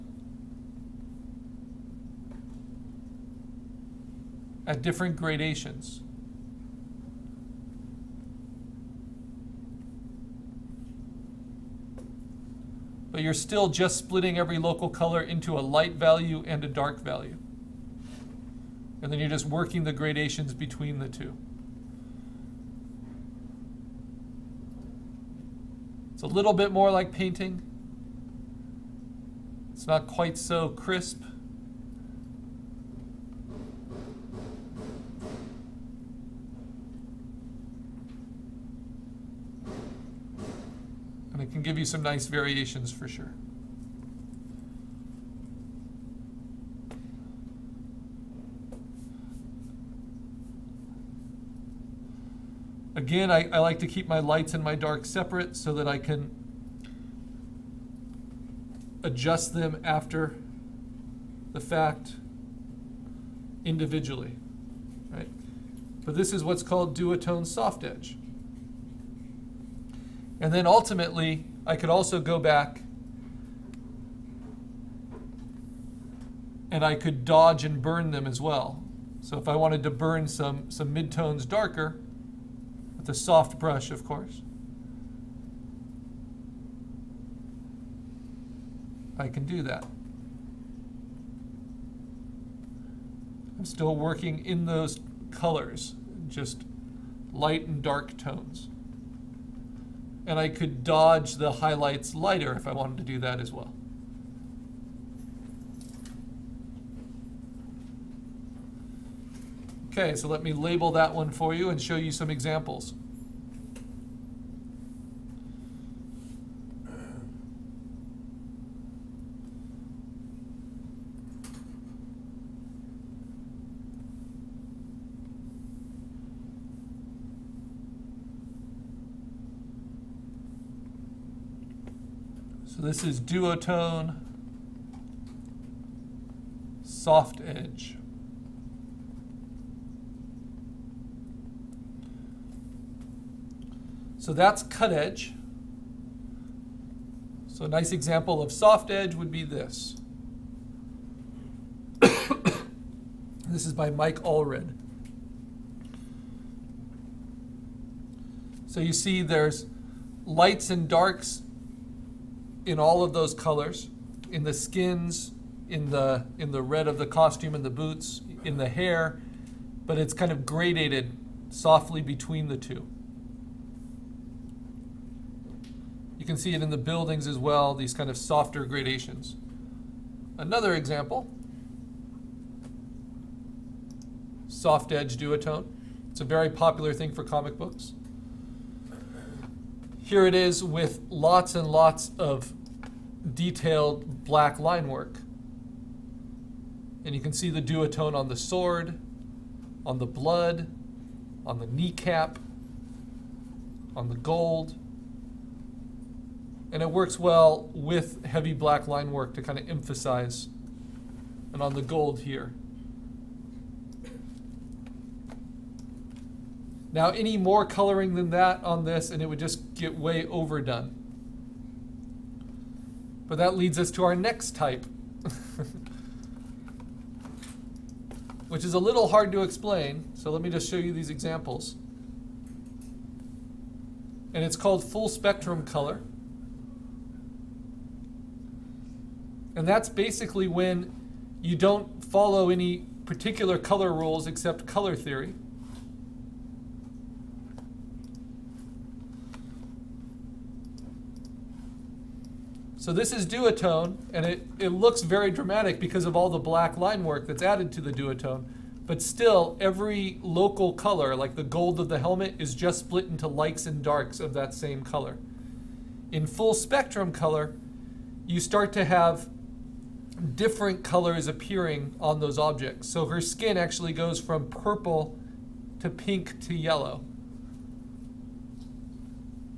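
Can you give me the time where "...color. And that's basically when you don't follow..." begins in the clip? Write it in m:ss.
3:55.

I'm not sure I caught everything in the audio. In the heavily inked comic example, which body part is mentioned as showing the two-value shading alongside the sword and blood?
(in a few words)
Kneecap.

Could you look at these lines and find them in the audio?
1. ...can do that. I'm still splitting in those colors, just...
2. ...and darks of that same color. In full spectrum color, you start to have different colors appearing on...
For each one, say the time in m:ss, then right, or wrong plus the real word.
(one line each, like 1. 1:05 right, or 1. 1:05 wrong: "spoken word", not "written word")
1. 1:29 wrong: "working", not "splitting"
2. 4:23 right.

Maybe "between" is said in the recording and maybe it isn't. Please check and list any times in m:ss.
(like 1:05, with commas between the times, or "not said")
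0:20, 2:52.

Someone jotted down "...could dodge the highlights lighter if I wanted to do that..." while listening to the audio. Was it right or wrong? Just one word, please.
right.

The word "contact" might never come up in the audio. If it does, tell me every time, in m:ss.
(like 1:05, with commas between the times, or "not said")
not said.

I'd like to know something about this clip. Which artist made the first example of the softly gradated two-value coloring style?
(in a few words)
Mike Allred.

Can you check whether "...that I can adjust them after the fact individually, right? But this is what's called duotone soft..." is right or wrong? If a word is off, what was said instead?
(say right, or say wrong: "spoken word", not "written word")
right.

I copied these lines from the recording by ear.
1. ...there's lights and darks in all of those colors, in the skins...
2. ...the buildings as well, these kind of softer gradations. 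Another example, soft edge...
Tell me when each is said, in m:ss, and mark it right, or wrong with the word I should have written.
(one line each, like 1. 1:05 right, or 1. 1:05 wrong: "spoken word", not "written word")
1. 2:39 right
2. 2:56 right.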